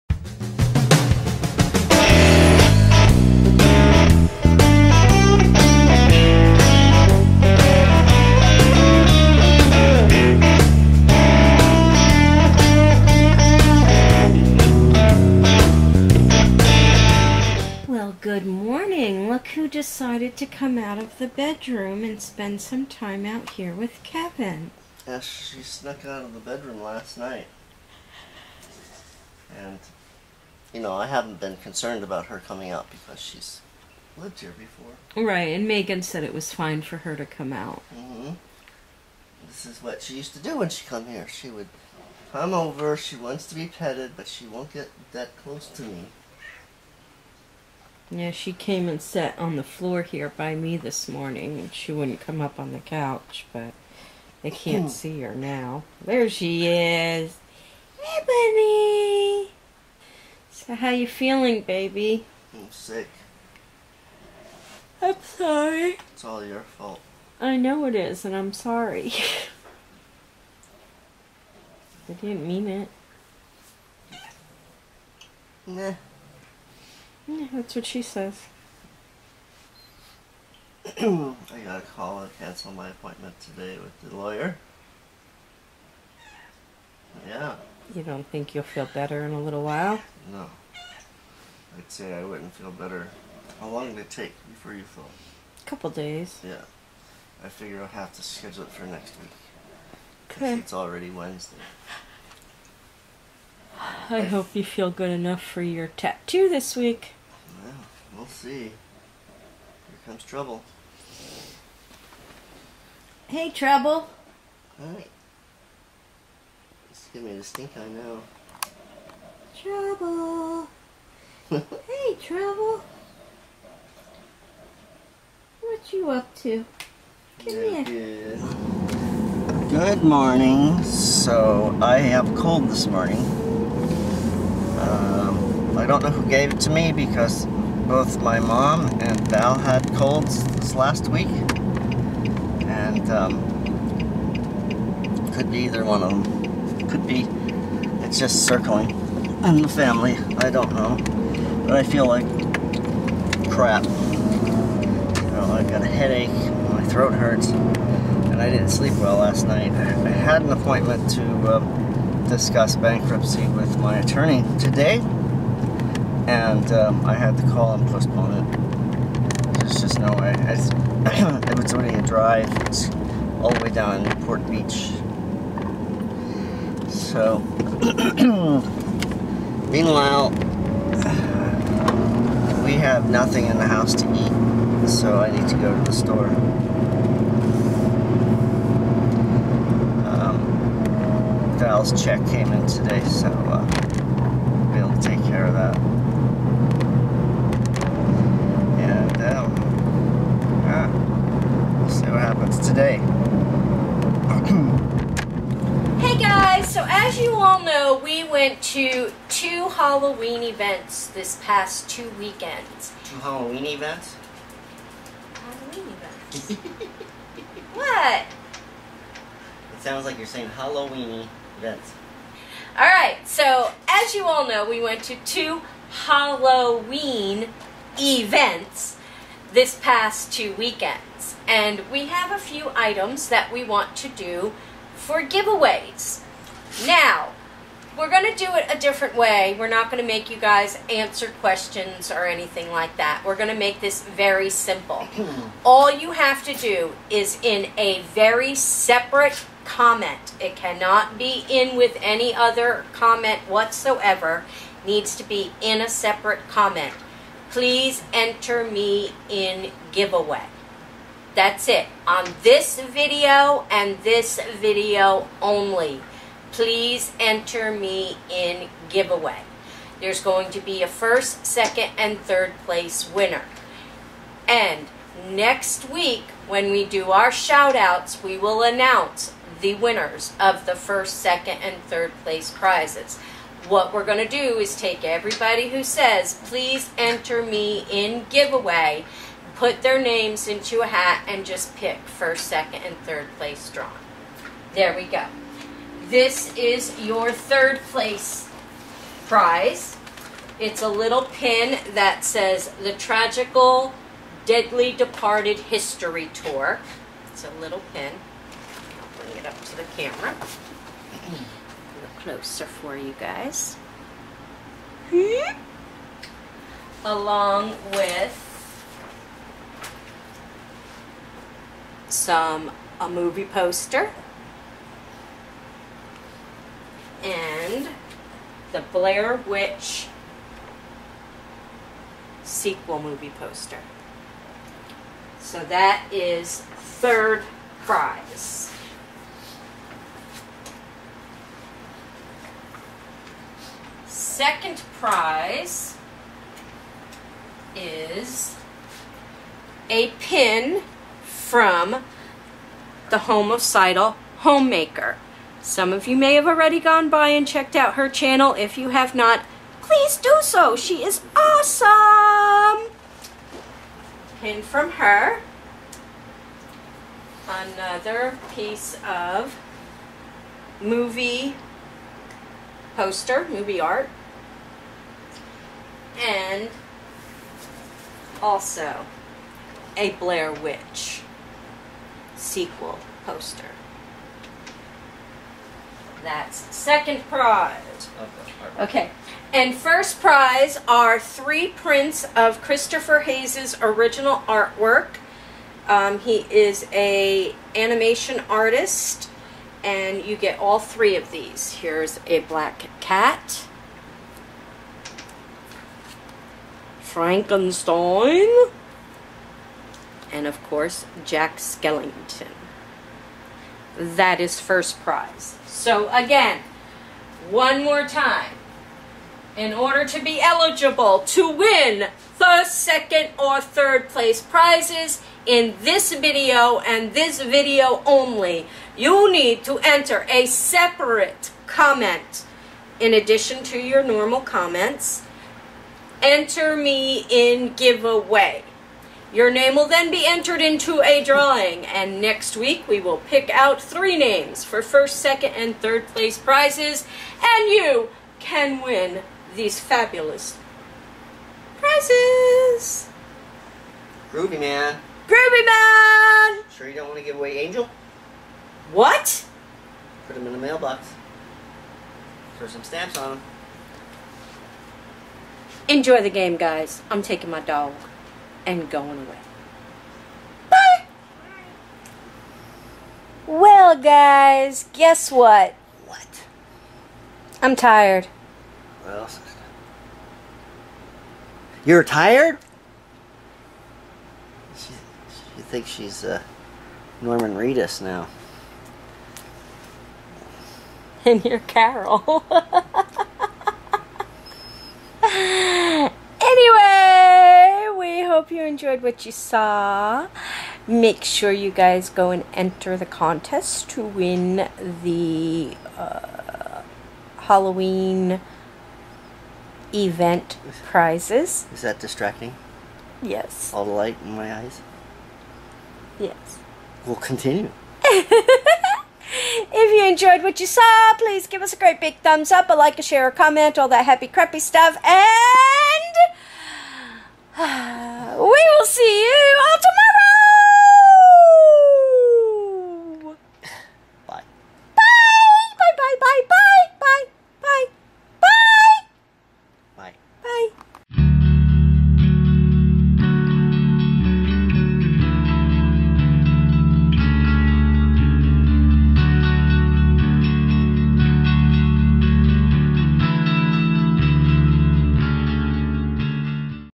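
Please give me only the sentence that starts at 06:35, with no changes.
Um, he is a animation artist, and you get all three of these.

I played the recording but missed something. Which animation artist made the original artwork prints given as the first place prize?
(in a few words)
Christopher Hayes.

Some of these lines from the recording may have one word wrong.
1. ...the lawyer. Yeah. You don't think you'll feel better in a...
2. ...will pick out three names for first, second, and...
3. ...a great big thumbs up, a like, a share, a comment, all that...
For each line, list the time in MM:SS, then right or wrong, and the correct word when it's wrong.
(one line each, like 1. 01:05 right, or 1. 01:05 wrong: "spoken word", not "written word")
1. 01:24 right
2. 07:22 right
3. 08:41 right.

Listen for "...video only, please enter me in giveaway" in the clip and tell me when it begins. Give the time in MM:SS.
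04:24.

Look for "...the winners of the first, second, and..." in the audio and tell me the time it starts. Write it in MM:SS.
04:39.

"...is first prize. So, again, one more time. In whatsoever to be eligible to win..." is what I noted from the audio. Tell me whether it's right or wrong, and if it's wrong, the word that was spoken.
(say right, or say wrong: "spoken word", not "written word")
wrong: "order", not "whatsoever".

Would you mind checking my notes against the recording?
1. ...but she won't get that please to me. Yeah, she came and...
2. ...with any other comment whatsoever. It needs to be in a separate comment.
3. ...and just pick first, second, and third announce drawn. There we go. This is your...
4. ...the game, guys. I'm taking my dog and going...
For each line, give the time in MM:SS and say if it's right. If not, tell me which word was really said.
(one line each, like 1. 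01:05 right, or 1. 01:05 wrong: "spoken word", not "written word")
1. 00:44 wrong: "close", not "please"
2. 04:11 right
3. 04:51 wrong: "place", not "announce"
4. 07:46 right.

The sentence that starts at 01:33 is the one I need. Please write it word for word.
How long did it take before you felt?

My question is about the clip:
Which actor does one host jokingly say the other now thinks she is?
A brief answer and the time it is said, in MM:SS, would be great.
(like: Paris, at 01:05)
Norman Reedus, at 08:07.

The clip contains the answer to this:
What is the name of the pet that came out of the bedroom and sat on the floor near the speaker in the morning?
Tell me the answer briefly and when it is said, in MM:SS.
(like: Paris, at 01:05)
Ebony, at 00:58.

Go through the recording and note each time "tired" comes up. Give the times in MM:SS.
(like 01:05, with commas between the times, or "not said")
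07:57, 08:02.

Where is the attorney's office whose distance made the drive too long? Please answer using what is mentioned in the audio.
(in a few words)
Port Beach.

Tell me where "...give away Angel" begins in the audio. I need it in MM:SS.
07:37.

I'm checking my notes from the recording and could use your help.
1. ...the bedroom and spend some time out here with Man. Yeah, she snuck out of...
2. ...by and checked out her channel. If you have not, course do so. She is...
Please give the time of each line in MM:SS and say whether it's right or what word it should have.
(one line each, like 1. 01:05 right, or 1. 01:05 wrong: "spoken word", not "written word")
1. 00:21 wrong: "Kevin", not "Man"
2. 05:57 wrong: "please", not "course".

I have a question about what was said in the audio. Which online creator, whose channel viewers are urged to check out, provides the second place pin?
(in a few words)
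The Homicidal Homemaker.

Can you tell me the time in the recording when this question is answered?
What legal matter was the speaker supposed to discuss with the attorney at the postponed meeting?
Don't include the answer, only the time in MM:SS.
02:42.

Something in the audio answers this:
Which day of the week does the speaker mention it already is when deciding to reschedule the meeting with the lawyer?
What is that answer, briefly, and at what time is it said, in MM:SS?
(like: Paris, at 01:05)
Wednesday, at 01:41.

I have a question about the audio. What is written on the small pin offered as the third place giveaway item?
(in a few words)
Tragically Deadly Departed History Tour.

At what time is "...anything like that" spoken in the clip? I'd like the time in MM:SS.
04:02.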